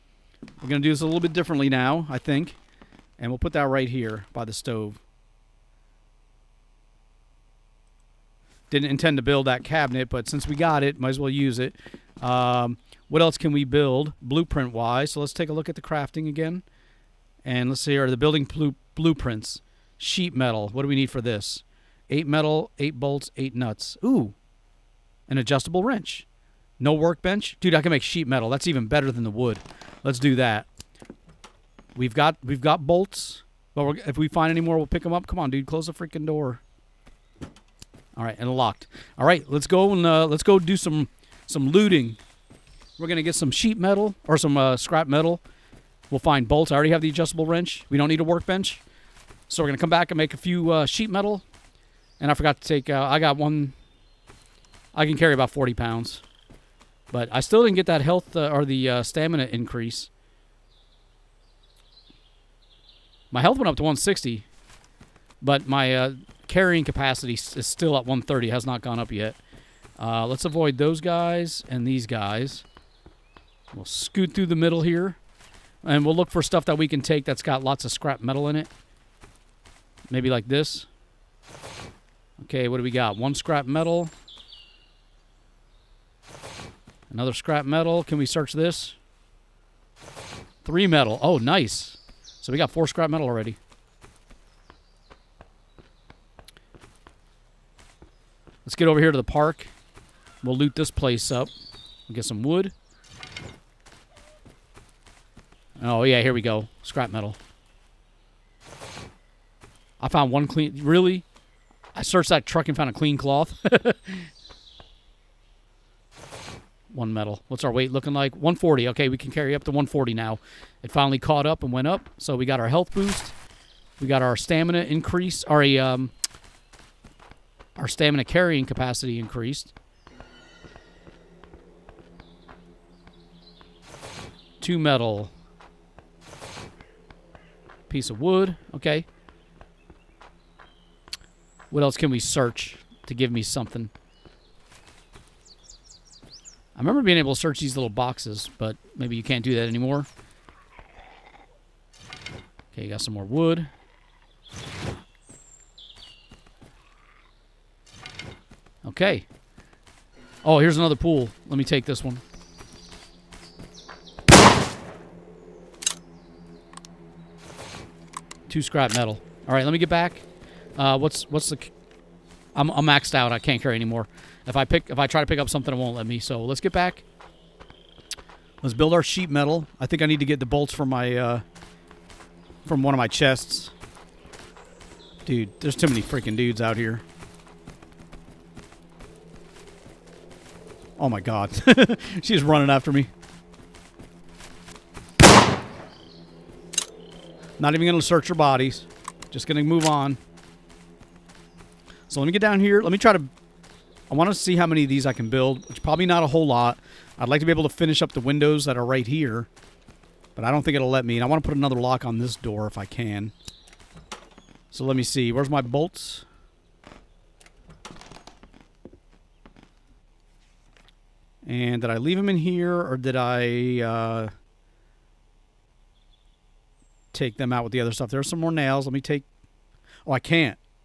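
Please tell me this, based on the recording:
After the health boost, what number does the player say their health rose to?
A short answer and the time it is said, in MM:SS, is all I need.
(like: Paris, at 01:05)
160, at 01:03.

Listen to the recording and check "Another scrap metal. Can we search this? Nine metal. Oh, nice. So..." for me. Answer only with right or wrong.
wrong.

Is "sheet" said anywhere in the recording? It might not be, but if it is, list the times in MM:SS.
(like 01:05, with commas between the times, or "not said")
00:19, 00:28, 00:43, 00:50, 02:59.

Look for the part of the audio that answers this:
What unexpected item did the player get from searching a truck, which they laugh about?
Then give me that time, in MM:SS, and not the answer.
01:52.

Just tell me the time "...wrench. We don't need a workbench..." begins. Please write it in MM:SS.
00:47.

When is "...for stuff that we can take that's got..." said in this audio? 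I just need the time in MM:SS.
01:16.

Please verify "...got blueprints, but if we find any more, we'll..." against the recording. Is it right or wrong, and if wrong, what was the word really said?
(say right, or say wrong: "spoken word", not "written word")
wrong: "bolts", not "blueprints".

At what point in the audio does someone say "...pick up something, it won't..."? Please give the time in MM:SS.
02:55.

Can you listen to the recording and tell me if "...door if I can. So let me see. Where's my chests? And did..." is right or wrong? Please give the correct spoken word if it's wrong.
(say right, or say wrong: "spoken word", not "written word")
wrong: "bolts", not "chests".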